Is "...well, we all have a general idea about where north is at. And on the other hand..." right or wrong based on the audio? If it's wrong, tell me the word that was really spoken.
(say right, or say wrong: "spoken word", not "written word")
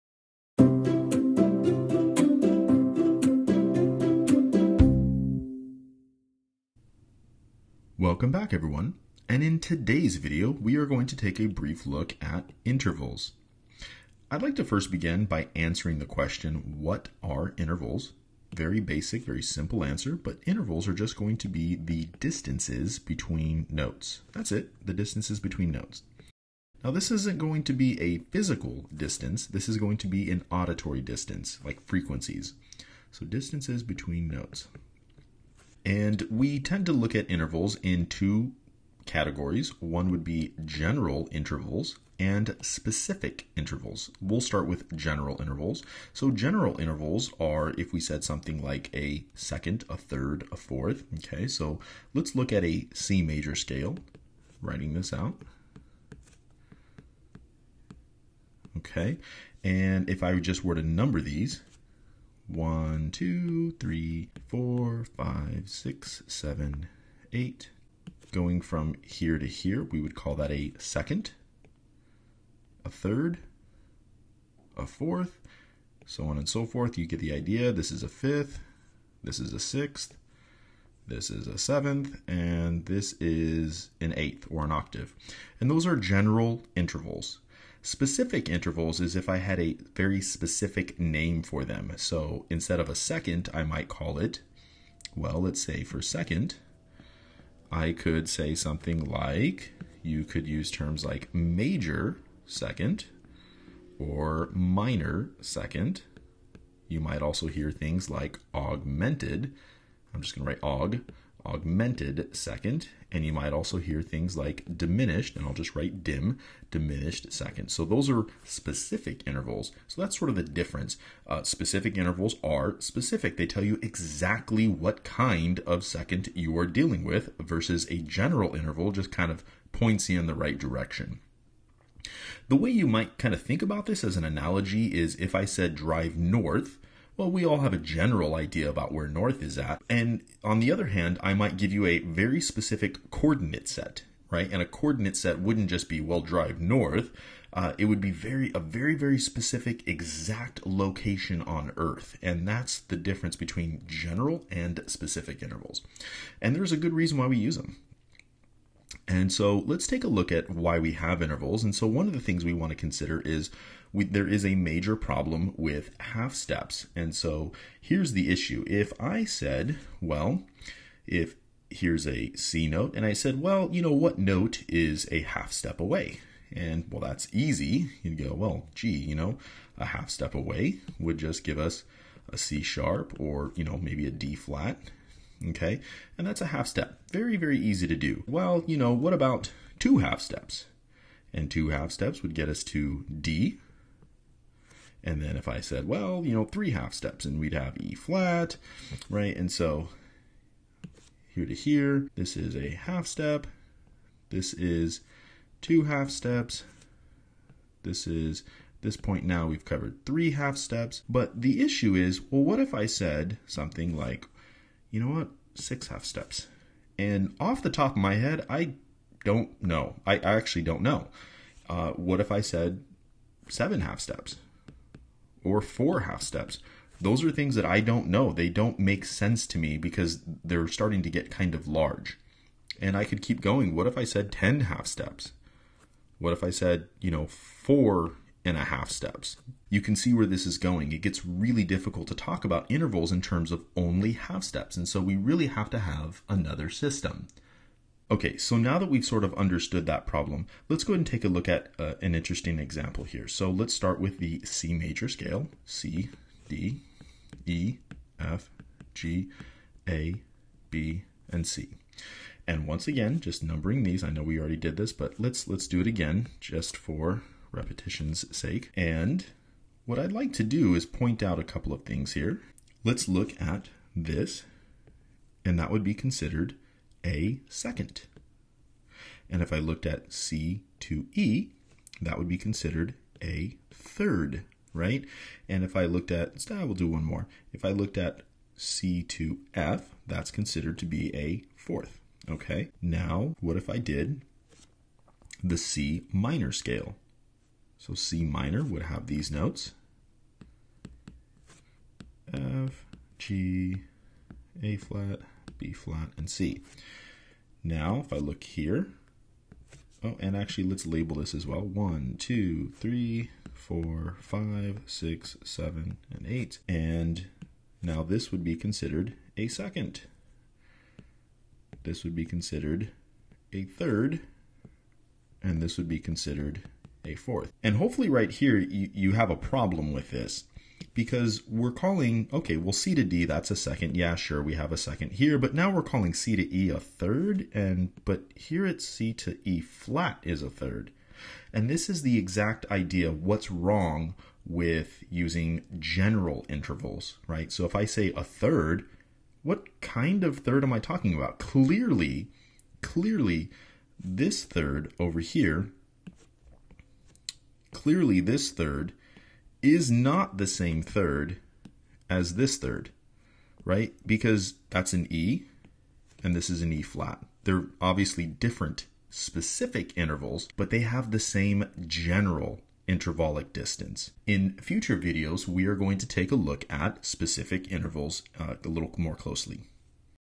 right.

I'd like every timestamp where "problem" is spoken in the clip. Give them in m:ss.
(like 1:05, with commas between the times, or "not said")
2:44, 4:10, 5:29.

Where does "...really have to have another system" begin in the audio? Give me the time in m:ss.
4:05.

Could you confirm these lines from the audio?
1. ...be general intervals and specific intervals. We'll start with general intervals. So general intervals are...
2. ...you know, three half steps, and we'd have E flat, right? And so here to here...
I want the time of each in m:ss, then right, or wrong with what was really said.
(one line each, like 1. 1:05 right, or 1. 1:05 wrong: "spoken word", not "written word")
1. 0:40 right
2. 3:16 right.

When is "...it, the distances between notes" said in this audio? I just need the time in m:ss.
0:24.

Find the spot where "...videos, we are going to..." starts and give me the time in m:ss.
6:14.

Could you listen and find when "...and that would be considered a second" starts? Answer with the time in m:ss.
4:35.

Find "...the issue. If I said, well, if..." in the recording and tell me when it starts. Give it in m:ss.
2:48.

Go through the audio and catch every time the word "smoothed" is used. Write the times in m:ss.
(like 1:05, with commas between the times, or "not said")
not said.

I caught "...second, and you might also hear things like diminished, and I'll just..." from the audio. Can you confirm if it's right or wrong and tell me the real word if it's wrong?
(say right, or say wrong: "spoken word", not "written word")
right.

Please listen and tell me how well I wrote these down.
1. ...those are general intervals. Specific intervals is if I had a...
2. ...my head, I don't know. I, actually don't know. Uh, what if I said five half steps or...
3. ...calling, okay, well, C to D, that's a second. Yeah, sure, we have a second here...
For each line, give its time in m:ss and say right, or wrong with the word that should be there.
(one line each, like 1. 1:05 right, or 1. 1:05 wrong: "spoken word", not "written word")
1. 1:25 right
2. 3:37 wrong: "seven", not "five"
3. 5:31 right.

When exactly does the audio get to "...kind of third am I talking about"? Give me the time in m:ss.
5:49.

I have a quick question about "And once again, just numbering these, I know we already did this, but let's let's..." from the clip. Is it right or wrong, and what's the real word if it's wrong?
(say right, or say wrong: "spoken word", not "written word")
right.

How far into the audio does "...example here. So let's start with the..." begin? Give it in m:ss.
4:12.